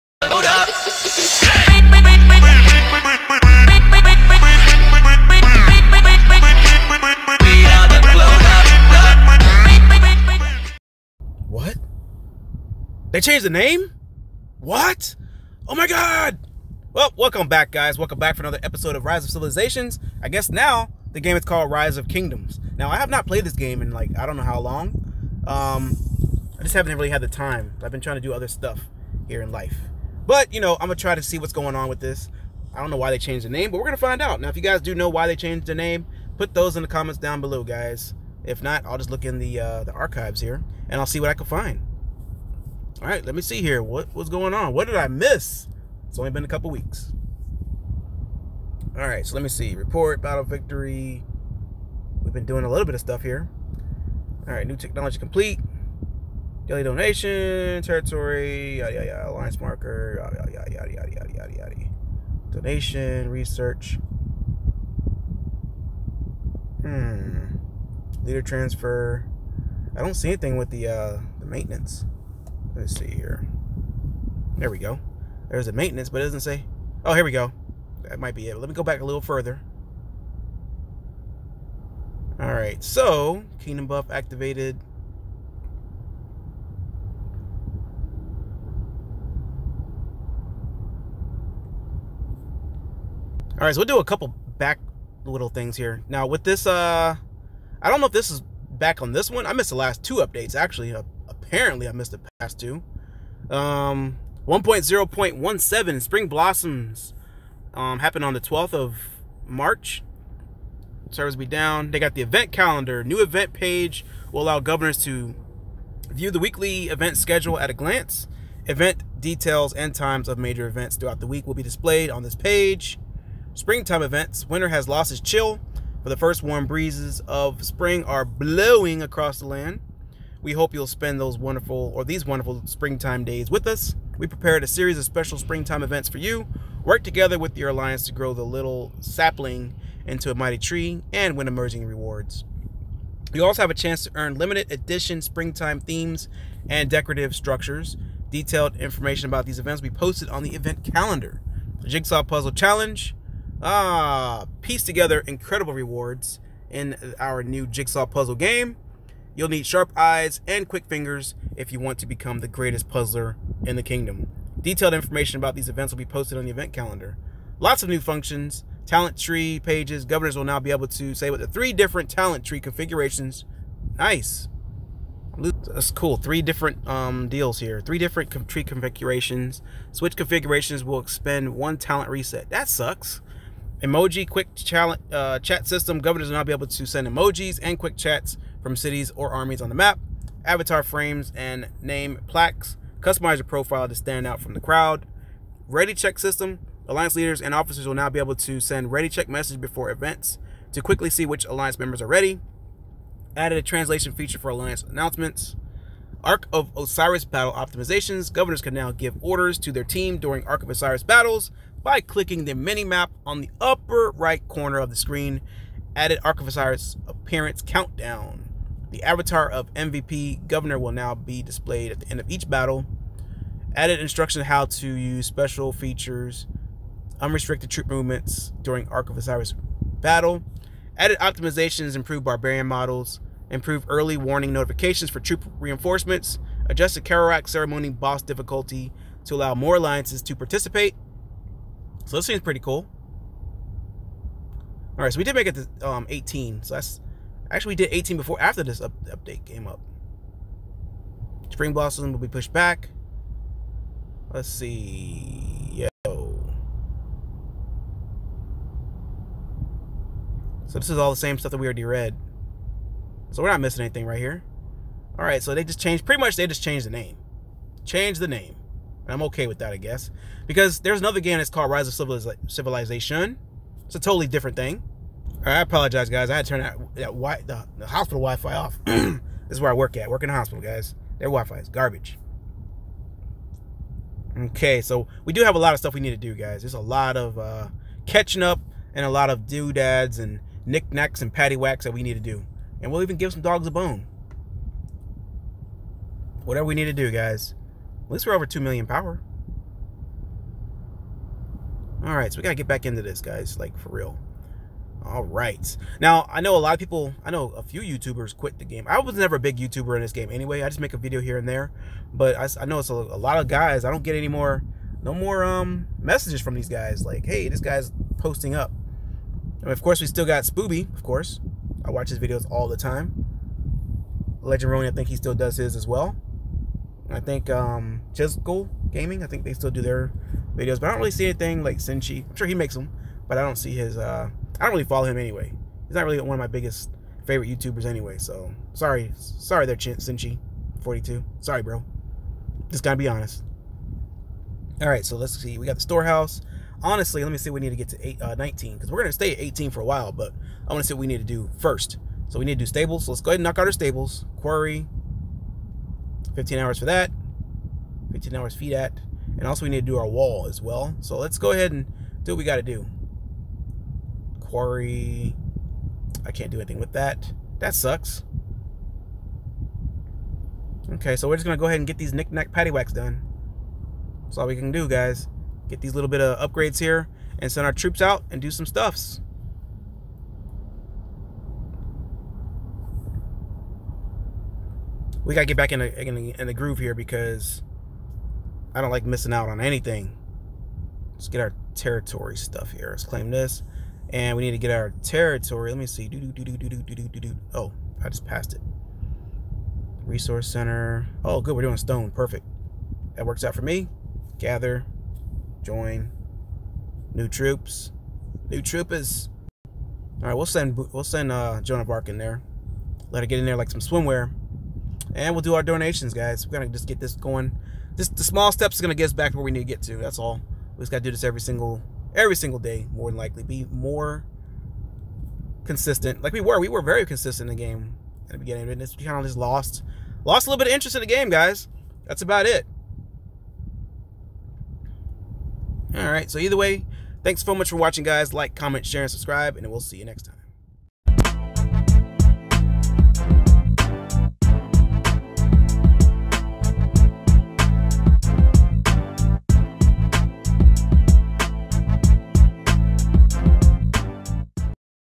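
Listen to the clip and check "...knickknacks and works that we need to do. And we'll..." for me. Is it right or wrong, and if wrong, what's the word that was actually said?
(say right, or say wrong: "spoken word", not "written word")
wrong: "paddywhacks", not "works".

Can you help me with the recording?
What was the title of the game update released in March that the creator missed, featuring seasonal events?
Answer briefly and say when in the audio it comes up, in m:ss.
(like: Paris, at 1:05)
Spring Blossoms, at 1:46.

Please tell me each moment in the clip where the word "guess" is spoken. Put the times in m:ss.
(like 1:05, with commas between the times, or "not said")
0:20, 4:29.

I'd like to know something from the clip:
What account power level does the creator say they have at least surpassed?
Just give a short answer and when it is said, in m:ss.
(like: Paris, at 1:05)
2 million, at 4:58.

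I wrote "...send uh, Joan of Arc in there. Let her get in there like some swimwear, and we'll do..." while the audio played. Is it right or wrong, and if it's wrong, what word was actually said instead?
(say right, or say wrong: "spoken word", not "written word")
right.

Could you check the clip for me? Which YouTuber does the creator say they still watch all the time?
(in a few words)
Spooby.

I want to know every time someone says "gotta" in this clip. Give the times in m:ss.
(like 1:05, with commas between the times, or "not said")
5:42, 6:25, 7:00.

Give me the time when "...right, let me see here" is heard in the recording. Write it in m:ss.
0:43.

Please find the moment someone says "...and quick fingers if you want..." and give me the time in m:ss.
2:40.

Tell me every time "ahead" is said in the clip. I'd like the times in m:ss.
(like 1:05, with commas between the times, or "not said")
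5:53, 6:01, 6:11.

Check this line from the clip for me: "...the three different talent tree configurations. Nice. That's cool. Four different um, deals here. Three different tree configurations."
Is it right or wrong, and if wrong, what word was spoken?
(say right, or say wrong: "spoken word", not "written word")
wrong: "Three", not "Four".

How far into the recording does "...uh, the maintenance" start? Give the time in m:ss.
1:10.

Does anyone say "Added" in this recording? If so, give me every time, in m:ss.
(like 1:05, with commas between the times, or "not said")
3:23, 3:35, 3:43, 3:50.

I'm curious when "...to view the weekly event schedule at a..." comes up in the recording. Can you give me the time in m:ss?
1:55.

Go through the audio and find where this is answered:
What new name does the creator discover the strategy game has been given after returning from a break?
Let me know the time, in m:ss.
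0:21.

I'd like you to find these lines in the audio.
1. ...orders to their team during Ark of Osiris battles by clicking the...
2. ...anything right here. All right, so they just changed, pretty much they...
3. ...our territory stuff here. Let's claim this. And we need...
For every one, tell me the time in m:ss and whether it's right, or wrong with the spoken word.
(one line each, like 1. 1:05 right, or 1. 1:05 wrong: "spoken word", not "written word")
1. 3:29 right
2. 4:23 right
3. 6:31 right.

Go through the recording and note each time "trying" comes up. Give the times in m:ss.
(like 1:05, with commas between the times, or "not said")
0:27.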